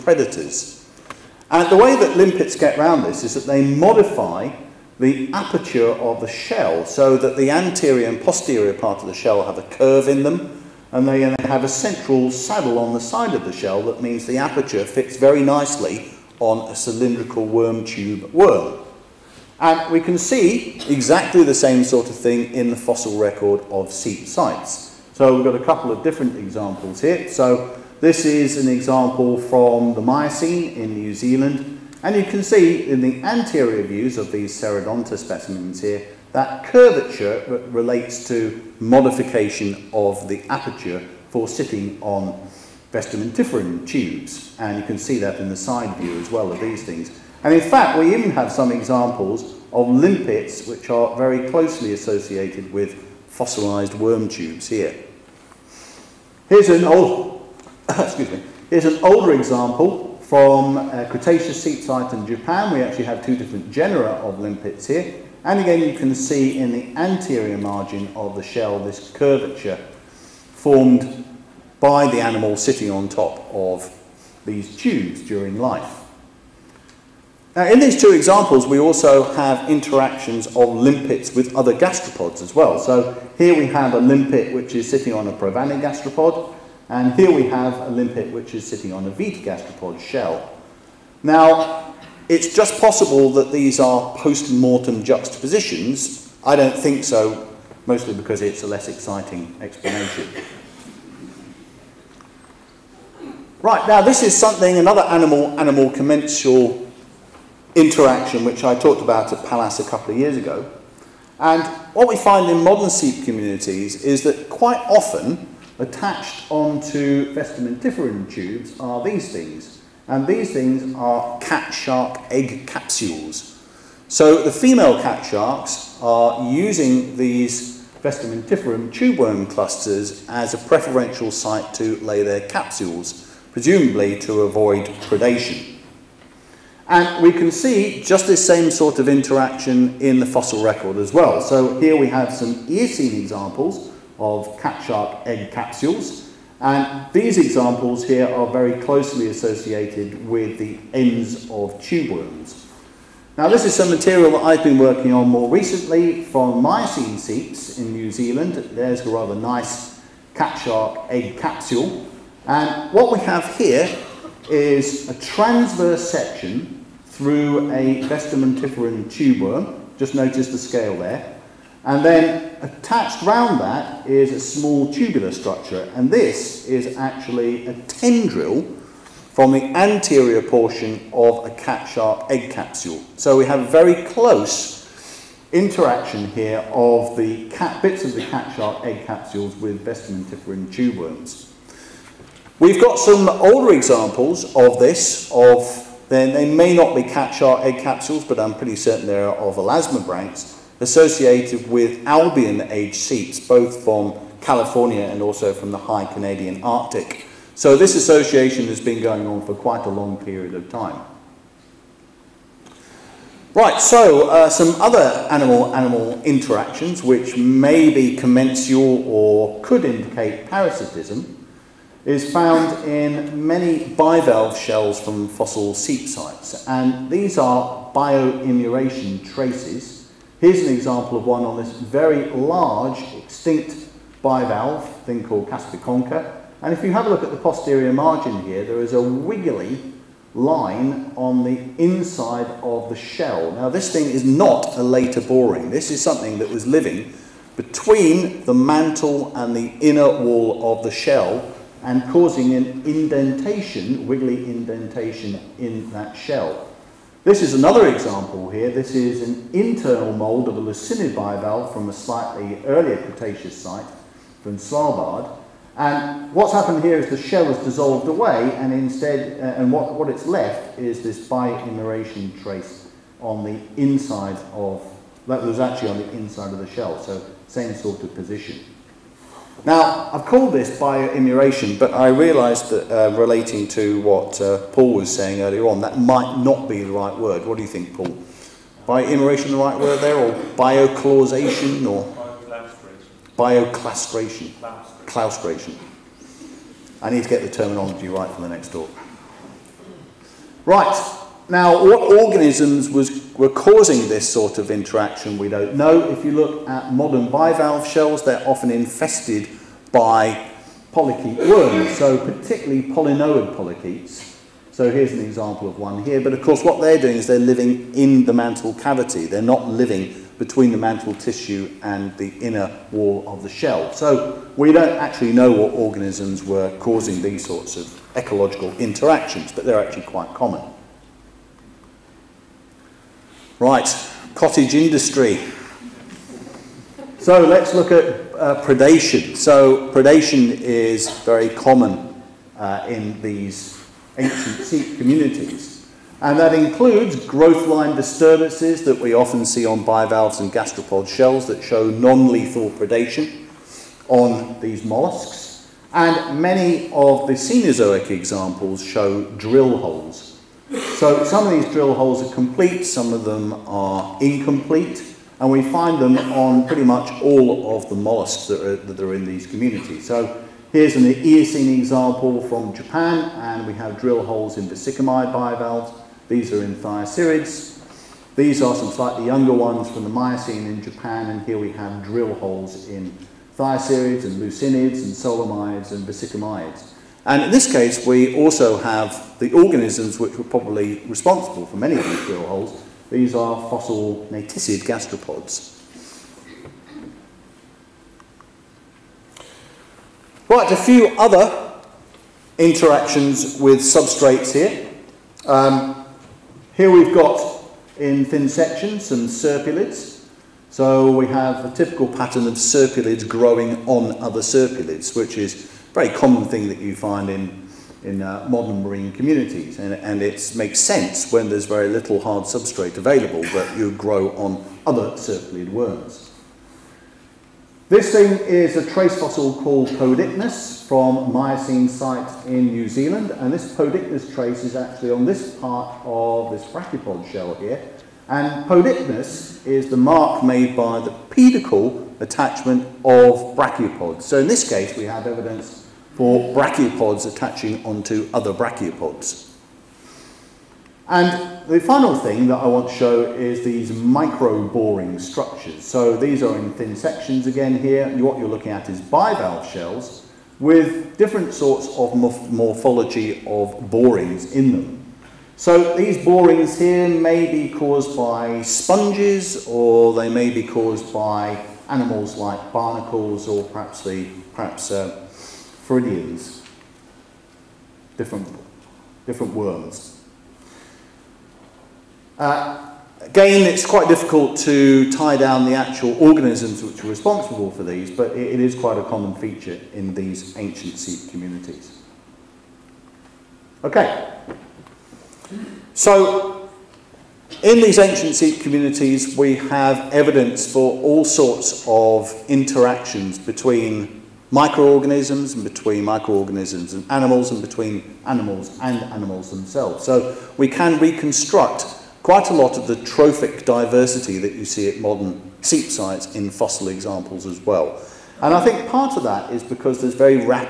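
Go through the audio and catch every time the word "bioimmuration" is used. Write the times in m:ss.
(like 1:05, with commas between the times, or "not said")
3:47, 4:31, 4:40, 4:48.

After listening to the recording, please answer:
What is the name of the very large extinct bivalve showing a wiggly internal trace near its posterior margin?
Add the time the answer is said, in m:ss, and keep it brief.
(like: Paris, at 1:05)
Caspiconcha, at 3:55.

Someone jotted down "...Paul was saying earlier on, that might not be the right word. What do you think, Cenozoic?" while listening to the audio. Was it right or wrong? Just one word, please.
wrong.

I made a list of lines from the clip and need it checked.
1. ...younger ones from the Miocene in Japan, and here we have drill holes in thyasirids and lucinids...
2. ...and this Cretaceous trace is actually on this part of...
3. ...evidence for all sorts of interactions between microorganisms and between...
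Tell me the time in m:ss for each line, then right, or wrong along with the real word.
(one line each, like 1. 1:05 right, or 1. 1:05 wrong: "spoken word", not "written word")
1. 6:19 right
2. 7:13 wrong: "Podichnus", not "Cretaceous"
3. 8:20 right.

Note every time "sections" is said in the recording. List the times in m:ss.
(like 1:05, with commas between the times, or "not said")
2:46, 6:48, 7:36.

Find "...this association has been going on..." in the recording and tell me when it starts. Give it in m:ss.
3:27.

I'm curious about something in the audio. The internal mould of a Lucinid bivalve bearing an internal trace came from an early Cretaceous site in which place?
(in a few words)
Svalbard.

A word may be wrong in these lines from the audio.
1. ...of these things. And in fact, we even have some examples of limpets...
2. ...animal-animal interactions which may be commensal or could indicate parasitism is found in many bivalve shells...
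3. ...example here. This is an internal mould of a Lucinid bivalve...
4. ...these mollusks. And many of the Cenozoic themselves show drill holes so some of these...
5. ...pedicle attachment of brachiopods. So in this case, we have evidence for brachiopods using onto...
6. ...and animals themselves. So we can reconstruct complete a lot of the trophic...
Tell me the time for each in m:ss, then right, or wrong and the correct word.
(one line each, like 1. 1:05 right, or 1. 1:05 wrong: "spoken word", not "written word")
1. 0:46 right
2. 3:35 right
3. 4:17 right
4. 5:54 wrong: "examples", not "themselves"
5. 7:21 wrong: "attaching", not "using"
6. 8:28 wrong: "quite", not "complete".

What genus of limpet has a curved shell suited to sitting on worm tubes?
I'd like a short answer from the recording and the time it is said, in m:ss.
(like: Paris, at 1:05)
Serradonta, at 0:34.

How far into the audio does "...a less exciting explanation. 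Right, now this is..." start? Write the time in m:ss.
1:38.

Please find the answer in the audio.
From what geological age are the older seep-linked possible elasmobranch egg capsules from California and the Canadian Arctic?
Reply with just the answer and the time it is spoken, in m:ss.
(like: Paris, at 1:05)
Albian, at 3:22.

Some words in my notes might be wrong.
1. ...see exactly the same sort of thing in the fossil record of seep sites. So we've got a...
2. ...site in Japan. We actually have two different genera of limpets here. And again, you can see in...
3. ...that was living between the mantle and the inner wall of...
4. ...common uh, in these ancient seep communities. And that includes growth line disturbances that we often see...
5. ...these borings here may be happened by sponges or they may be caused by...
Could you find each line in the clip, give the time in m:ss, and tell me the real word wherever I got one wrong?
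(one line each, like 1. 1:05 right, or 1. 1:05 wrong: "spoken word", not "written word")
1. 0:20 right
2. 1:01 right
3. 4:06 right
4. 5:41 right
5. 7:45 wrong: "caused", not "happened".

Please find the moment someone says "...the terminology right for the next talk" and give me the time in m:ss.
4:57.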